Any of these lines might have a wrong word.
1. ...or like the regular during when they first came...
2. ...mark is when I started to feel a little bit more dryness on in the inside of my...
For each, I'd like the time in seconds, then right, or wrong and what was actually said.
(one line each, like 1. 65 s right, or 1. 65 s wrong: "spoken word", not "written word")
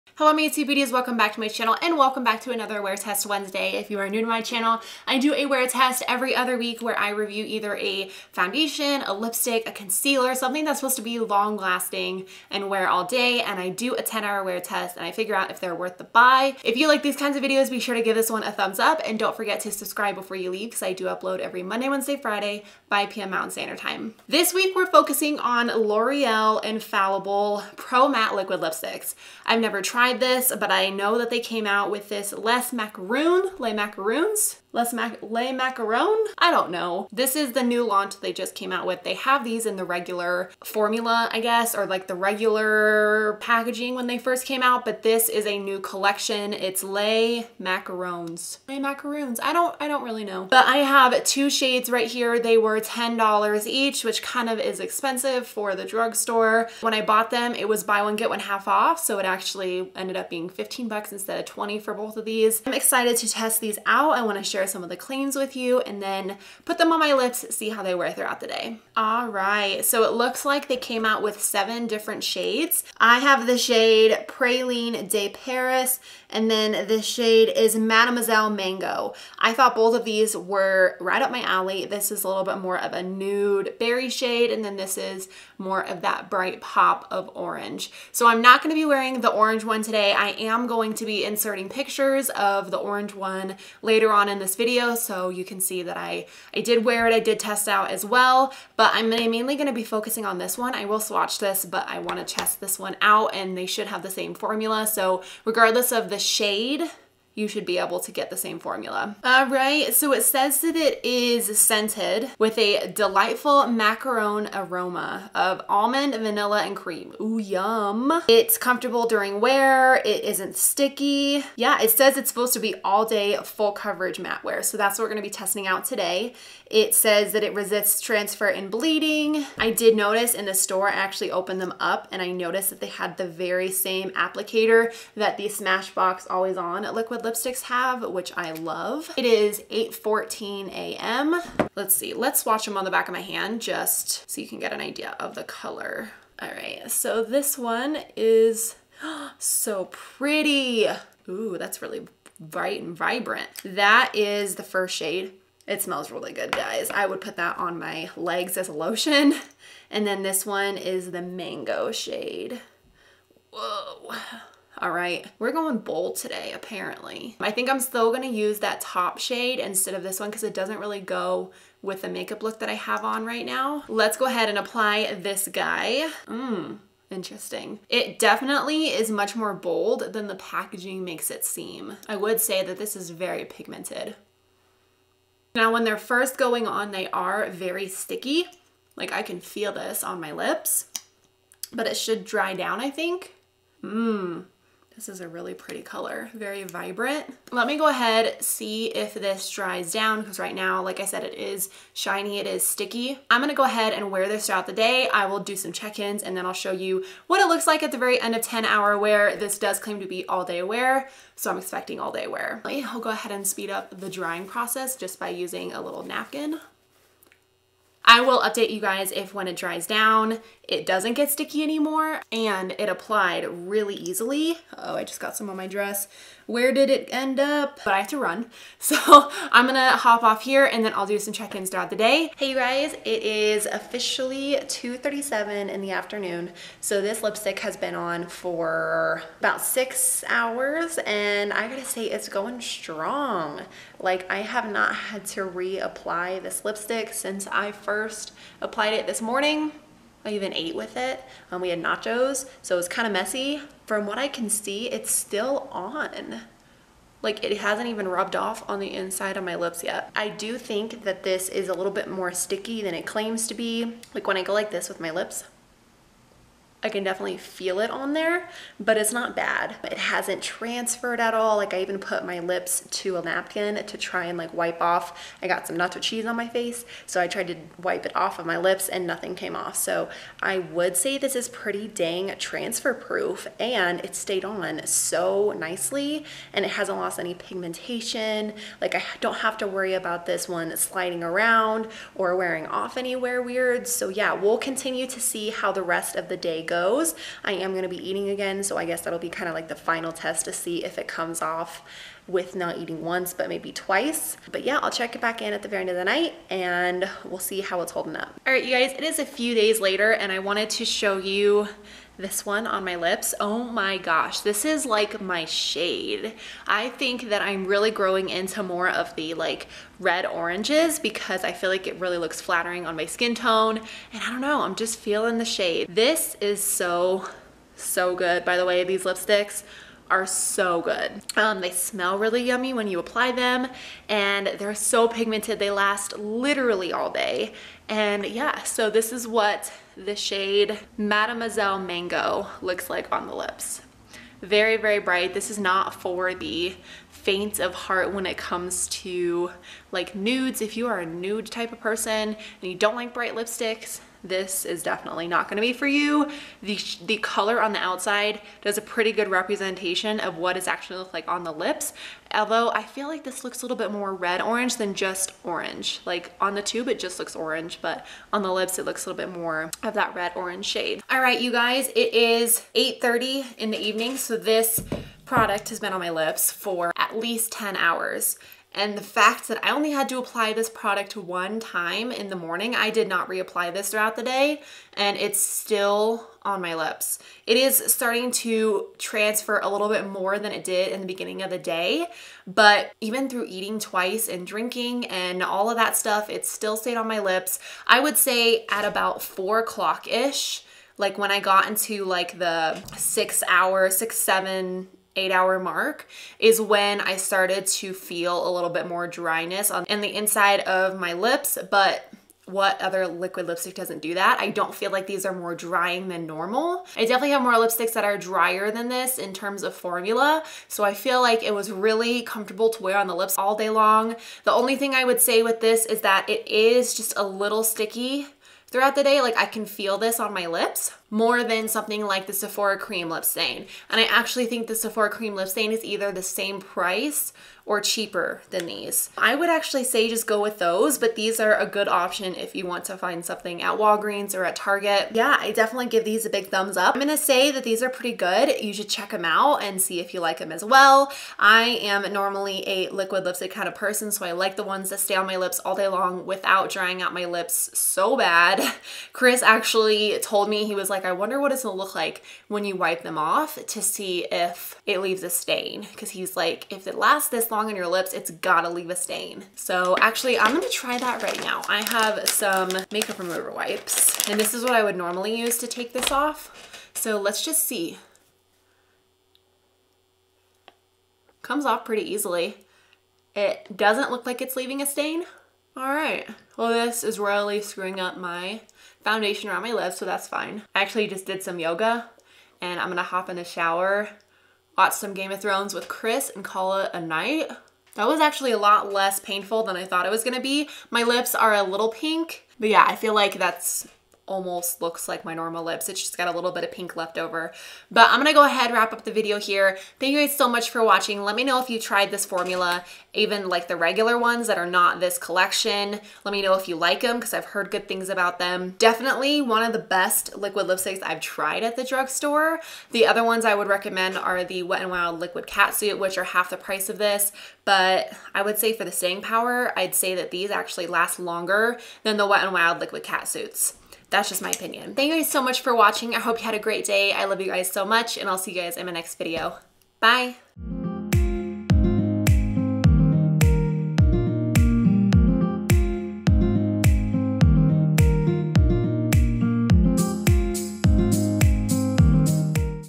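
1. 41 s wrong: "packaging", not "during"
2. 405 s right.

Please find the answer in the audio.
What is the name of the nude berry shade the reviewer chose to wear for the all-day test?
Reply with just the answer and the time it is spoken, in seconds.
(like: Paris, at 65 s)
Praline de Paris, at 74 s.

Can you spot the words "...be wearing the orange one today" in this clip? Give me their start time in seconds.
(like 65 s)
88 s.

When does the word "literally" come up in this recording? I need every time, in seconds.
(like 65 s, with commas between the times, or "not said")
336 s.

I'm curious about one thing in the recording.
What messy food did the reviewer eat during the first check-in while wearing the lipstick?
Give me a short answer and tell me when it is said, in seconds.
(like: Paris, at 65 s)
nachos, at 251 s.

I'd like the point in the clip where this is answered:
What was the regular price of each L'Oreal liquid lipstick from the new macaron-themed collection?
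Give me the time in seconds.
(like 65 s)
52 s.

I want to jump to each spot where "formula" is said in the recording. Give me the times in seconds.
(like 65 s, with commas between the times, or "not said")
40 s, 104 s, 108 s, 419 s, 512 s.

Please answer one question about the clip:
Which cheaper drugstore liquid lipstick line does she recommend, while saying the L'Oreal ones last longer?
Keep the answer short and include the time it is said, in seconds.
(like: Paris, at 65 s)
Wet n Wild Liquid Catsuit, at 524 s.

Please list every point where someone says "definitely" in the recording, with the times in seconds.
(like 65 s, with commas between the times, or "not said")
178 s, 267 s, 354 s, 417 s, 445 s, 518 s.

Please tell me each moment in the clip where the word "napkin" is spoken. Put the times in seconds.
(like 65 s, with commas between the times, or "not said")
216 s, 273 s.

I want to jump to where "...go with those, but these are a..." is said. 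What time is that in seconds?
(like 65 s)
440 s.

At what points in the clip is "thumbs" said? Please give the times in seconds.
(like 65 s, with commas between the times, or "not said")
18 s, 446 s.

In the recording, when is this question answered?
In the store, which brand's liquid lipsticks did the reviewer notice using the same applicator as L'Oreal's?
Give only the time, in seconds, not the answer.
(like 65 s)
135 s.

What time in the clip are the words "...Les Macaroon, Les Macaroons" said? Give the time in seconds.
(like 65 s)
32 s.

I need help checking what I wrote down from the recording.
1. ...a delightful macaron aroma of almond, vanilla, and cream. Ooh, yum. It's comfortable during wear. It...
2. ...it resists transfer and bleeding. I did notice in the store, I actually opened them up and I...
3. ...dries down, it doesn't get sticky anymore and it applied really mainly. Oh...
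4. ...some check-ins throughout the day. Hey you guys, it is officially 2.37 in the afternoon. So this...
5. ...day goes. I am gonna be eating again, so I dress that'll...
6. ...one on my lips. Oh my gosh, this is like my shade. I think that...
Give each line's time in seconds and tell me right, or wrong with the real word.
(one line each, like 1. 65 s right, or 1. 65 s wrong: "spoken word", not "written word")
1. 112 s right
2. 127 s right
3. 219 s wrong: "easily", not "mainly"
4. 231 s right
5. 296 s wrong: "guess", not "dress"
6. 312 s right.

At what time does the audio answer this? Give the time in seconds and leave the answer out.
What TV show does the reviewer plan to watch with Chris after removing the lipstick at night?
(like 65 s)
495 s.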